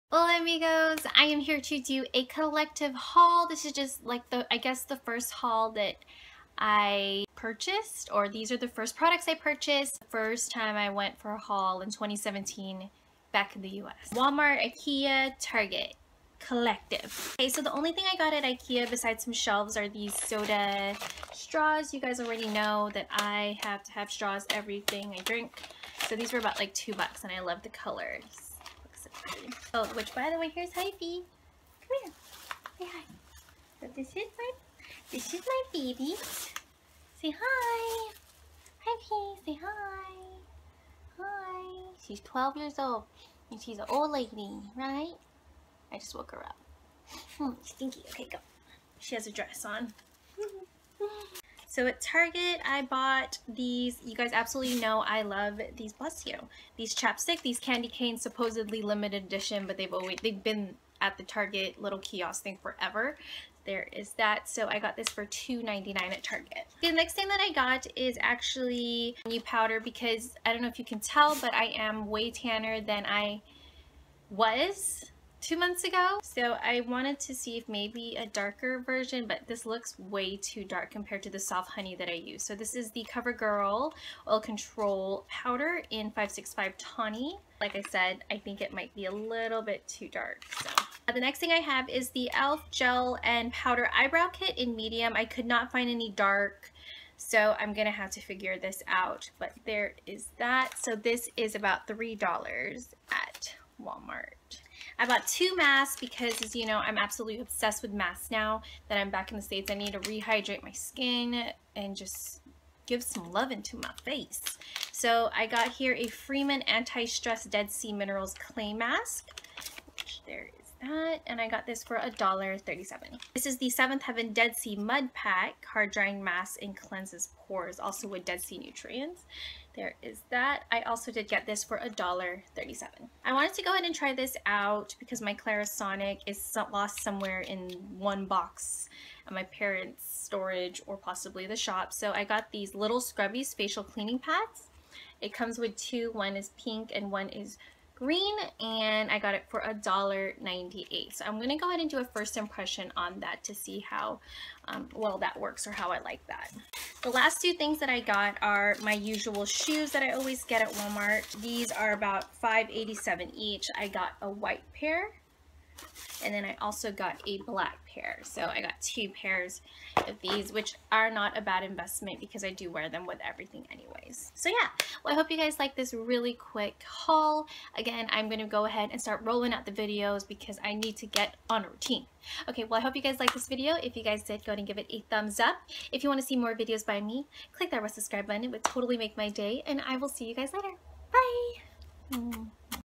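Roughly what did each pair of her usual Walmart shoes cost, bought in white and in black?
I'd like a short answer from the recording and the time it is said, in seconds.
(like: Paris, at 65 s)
$5.87, at 162 s.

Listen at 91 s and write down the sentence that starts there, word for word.
Uh, the next thing I have is the e.l.f.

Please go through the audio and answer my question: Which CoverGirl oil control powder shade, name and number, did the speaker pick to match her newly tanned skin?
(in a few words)
565 Tawny.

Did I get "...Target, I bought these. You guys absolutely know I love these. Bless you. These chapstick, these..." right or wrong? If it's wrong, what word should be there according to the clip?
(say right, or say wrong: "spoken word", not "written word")
right.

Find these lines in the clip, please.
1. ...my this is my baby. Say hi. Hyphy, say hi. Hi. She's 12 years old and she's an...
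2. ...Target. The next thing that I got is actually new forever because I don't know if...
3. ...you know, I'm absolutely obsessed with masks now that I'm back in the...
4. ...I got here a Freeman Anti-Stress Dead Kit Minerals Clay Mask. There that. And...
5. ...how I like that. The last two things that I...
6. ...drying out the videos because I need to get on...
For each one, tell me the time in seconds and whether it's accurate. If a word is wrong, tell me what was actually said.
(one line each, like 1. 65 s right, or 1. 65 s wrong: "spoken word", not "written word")
1. 34 s right
2. 66 s wrong: "powder", not "forever"
3. 106 s right
4. 115 s wrong: "Sea", not "Kit"
5. 155 s right
6. 179 s wrong: "rolling", not "drying".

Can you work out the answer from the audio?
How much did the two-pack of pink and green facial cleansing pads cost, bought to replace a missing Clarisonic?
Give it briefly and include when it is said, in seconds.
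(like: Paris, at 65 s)
$1.98, at 149 s.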